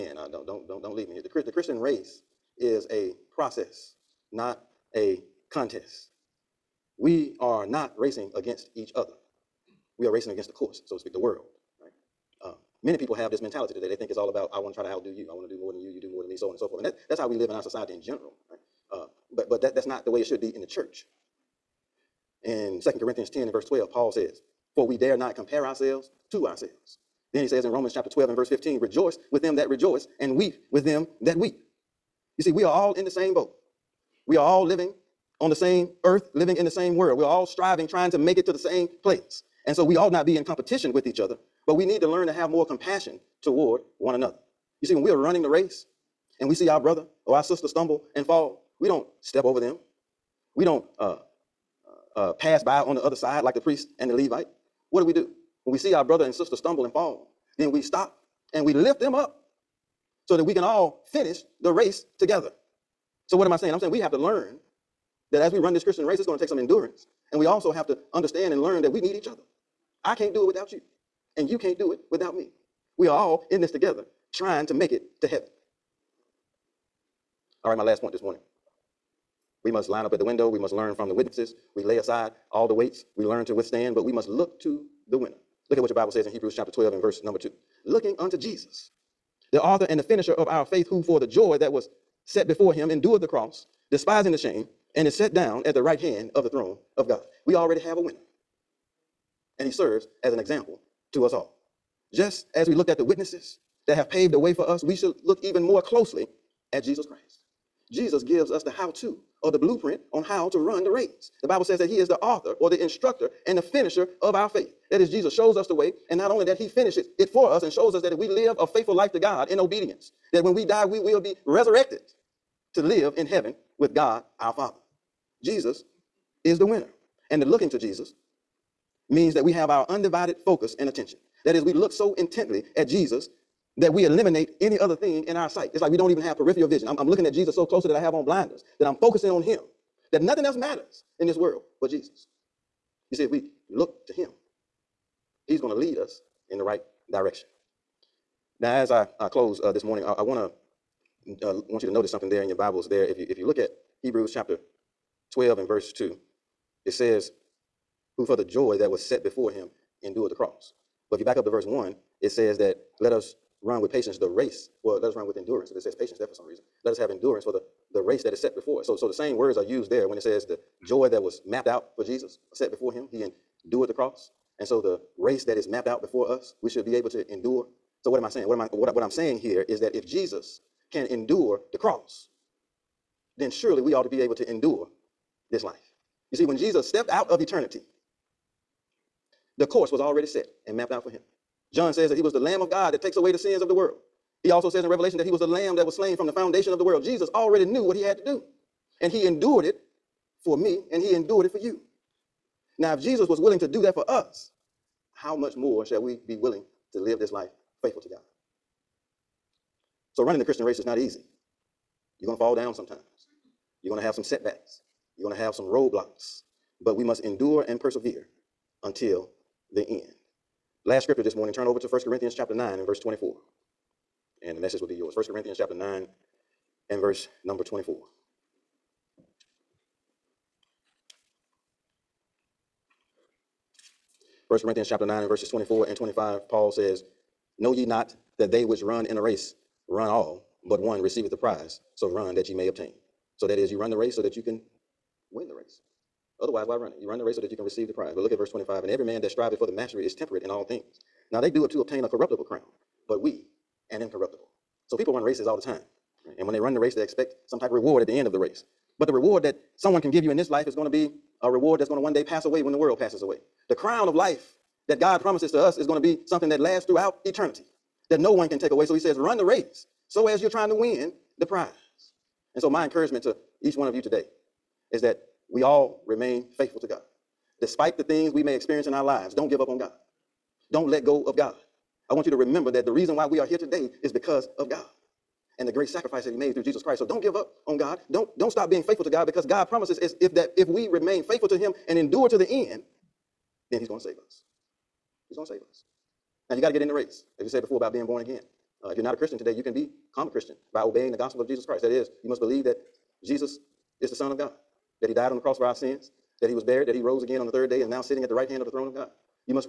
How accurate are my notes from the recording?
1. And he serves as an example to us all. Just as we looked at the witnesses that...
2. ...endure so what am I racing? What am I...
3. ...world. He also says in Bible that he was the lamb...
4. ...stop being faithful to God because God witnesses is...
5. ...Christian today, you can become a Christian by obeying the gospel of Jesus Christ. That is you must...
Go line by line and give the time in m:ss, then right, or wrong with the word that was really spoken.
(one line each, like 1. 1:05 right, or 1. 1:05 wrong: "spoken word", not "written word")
1. 1:39 right
2. 2:57 wrong: "saying", not "racing"
3. 3:13 wrong: "Revelation", not "Bible"
4. 4:48 wrong: "promises", not "witnesses"
5. 4:59 right.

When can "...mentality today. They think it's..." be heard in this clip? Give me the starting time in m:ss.
0:13.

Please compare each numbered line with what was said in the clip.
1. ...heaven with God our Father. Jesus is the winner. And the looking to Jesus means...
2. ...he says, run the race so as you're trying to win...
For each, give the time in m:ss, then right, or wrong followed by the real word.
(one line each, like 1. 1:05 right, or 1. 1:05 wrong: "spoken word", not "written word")
1. 2:03 right
2. 4:28 right.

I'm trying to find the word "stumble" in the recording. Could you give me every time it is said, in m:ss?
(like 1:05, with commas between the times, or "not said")
0:47, 0:56.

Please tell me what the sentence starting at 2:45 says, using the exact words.
If it says patience there for some reason, let us have endurance for the, the race that is set before us.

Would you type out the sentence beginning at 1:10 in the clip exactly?
I can't do it without you, and you can't do it without me.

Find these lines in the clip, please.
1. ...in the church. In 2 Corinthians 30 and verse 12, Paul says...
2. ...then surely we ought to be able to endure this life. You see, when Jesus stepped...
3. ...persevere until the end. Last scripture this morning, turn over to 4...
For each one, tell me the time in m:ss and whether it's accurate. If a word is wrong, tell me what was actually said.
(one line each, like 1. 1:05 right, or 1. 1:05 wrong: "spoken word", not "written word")
1. 0:20 wrong: "10", not "30"
2. 3:03 right
3. 3:37 wrong: "1", not "4".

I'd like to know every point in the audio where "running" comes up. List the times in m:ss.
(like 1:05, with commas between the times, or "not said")
0:45, 3:30.